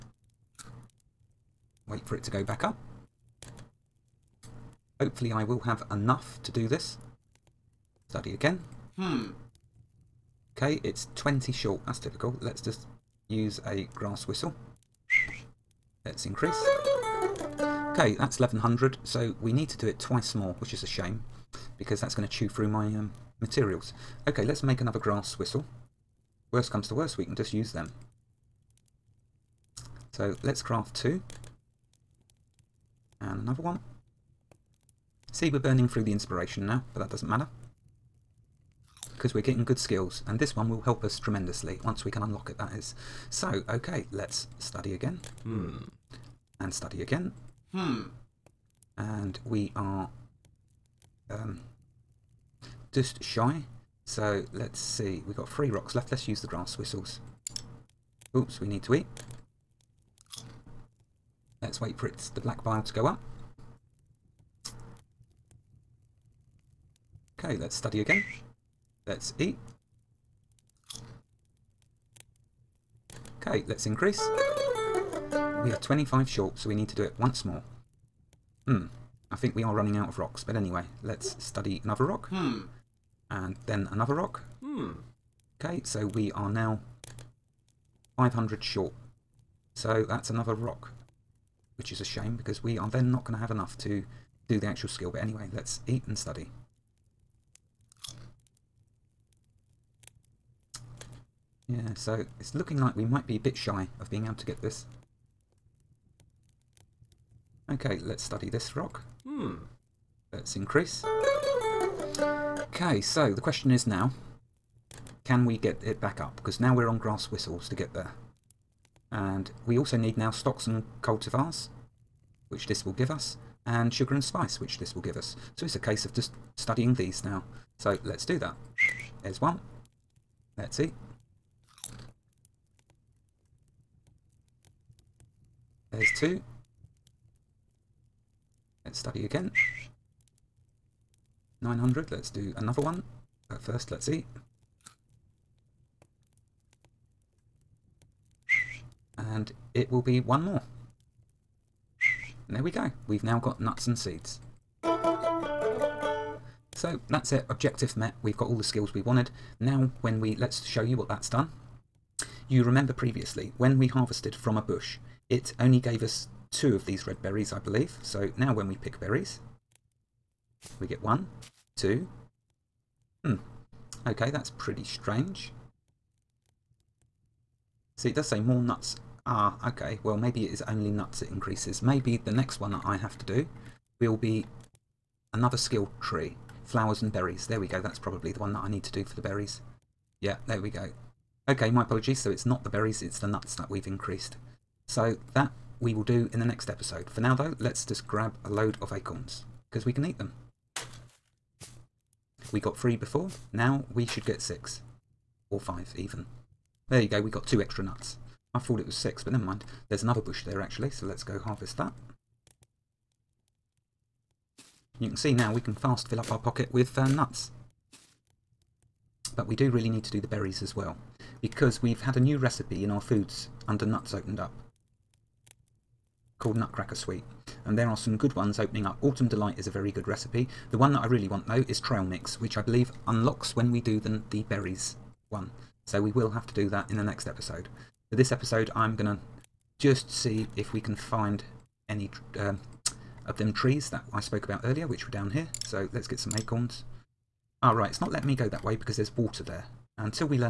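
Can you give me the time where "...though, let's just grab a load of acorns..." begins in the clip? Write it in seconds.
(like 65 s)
197 s.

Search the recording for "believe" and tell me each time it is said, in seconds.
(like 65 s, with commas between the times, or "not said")
167 s, 232 s.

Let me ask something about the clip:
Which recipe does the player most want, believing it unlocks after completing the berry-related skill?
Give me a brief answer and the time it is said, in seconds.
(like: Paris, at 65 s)
Trail Mix, at 231 s.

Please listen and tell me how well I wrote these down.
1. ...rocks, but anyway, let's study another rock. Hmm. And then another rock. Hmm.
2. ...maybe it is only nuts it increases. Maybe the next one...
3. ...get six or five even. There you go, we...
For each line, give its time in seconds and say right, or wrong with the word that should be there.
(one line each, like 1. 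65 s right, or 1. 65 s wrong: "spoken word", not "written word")
1. 80 s right
2. 180 s right
3. 204 s right.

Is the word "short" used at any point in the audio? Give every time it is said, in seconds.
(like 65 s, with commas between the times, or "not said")
11 s, 76 s, 88 s.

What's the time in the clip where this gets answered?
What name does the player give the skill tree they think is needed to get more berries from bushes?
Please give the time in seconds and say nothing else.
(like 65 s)
186 s.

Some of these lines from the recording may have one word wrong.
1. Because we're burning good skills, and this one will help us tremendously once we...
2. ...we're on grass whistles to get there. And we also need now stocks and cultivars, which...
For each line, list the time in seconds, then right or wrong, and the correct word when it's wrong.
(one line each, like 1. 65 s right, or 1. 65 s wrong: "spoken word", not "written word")
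1. 39 s wrong: "getting", not "burning"
2. 116 s right.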